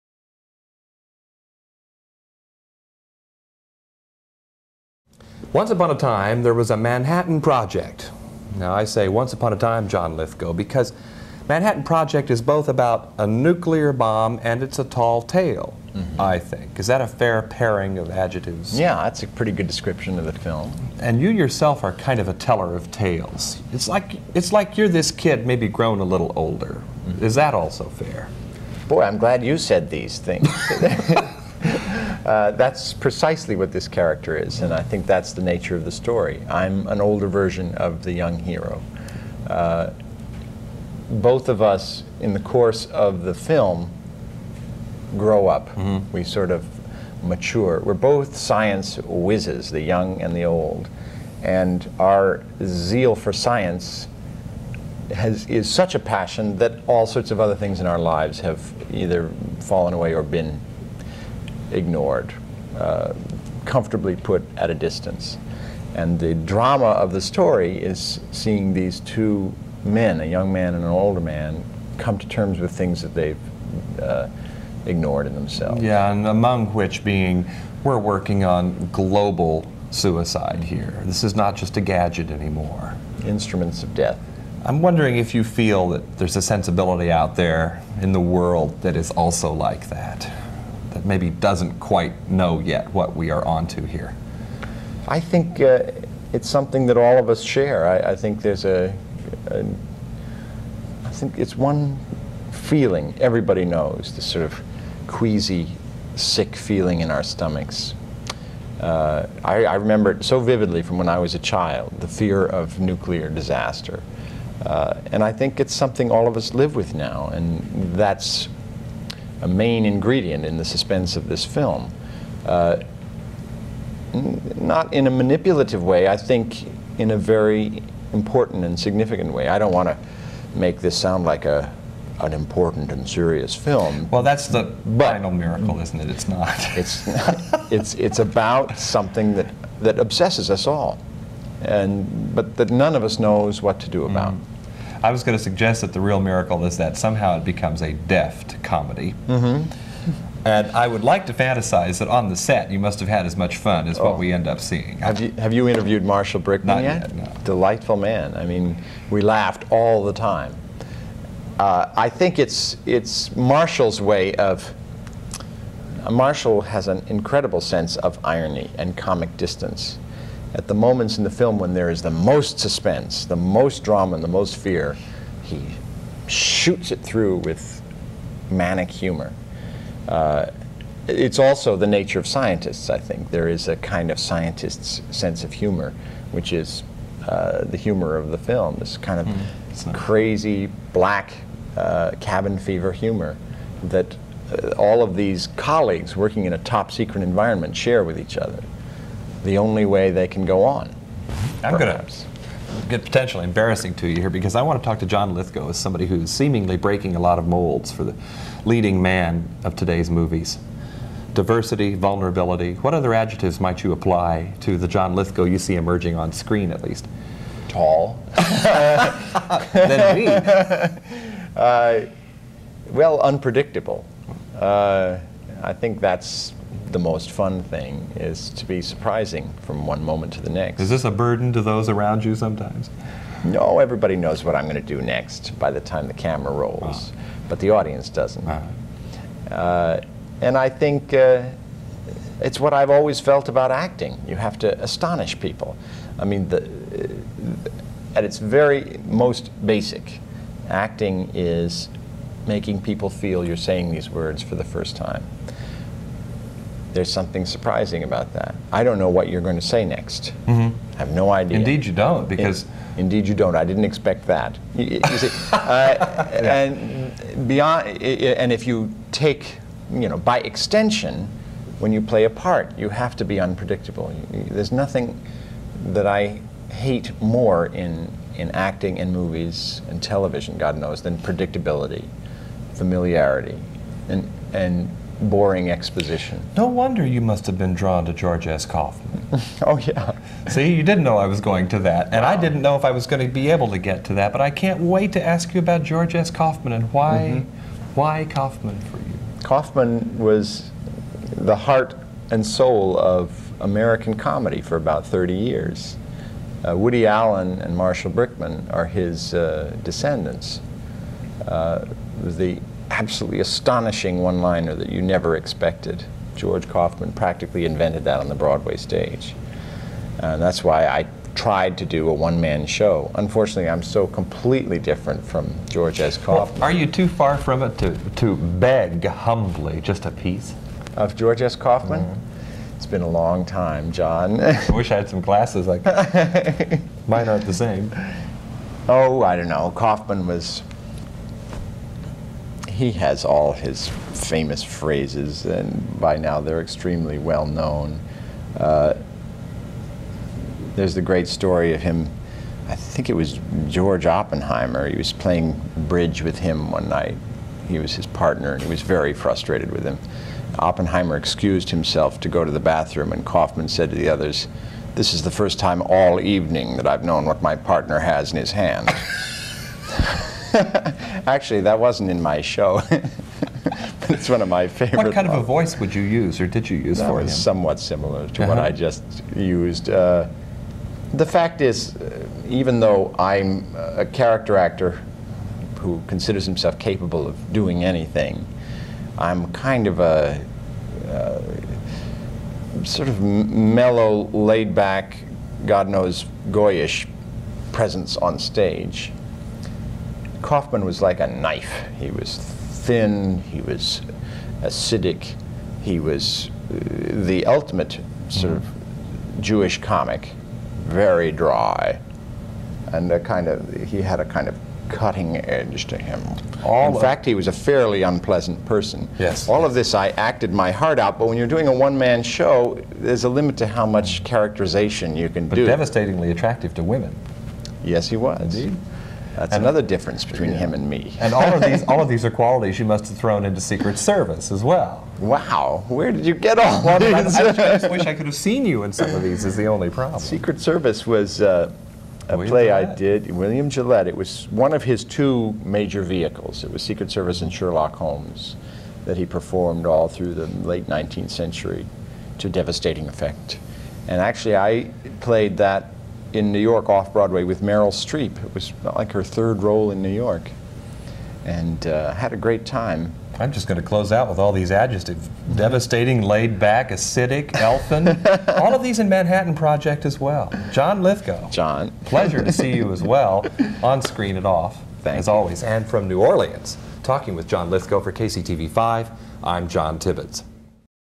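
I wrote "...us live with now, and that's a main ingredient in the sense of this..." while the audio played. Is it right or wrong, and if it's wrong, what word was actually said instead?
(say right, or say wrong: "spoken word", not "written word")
wrong: "suspense", not "sense".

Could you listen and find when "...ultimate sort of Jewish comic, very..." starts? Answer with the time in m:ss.
6:47.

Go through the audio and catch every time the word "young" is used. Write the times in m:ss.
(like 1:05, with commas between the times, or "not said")
0:38, 0:49, 1:10.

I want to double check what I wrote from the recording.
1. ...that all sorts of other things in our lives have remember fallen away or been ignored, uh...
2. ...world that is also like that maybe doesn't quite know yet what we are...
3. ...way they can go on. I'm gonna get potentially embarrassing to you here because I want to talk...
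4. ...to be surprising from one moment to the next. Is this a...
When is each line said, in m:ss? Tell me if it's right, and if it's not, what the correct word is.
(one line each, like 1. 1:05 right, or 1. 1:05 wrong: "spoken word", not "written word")
1. 0:56 wrong: "either", not "remember"
2. 1:28 right
3. 3:19 right
4. 3:48 right.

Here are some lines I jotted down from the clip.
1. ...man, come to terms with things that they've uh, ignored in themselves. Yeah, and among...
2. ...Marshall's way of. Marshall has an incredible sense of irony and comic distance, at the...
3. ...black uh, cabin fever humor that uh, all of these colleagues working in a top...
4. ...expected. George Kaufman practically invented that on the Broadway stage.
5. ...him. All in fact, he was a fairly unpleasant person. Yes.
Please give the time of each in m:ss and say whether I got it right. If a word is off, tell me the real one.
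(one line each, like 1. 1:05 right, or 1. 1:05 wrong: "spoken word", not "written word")
1. 1:11 right
2. 2:43 right
3. 3:10 right
4. 5:15 right
5. 6:55 right.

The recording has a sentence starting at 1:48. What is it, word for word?
Uh, I, I, remember it so vividly from when I was a child, the fear of nuclear disaster.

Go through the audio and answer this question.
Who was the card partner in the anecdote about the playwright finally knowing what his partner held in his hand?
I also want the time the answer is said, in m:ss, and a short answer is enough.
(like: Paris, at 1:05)
George Oppenheimer, at 5:53.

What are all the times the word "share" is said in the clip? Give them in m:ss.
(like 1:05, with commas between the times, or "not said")
1:37, 3:17.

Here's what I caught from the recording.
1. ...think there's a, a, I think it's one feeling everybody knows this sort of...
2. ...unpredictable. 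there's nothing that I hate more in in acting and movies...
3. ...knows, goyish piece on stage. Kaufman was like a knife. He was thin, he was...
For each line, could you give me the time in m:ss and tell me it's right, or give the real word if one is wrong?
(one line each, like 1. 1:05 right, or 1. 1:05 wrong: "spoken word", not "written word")
1. 1:38 right
2. 4:33 right
3. 6:35 wrong: "presence", not "piece".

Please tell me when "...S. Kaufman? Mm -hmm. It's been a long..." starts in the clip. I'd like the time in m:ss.
5:31.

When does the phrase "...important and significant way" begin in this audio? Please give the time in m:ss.
2:08.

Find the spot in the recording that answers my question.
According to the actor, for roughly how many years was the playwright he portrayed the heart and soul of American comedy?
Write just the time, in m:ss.
5:05.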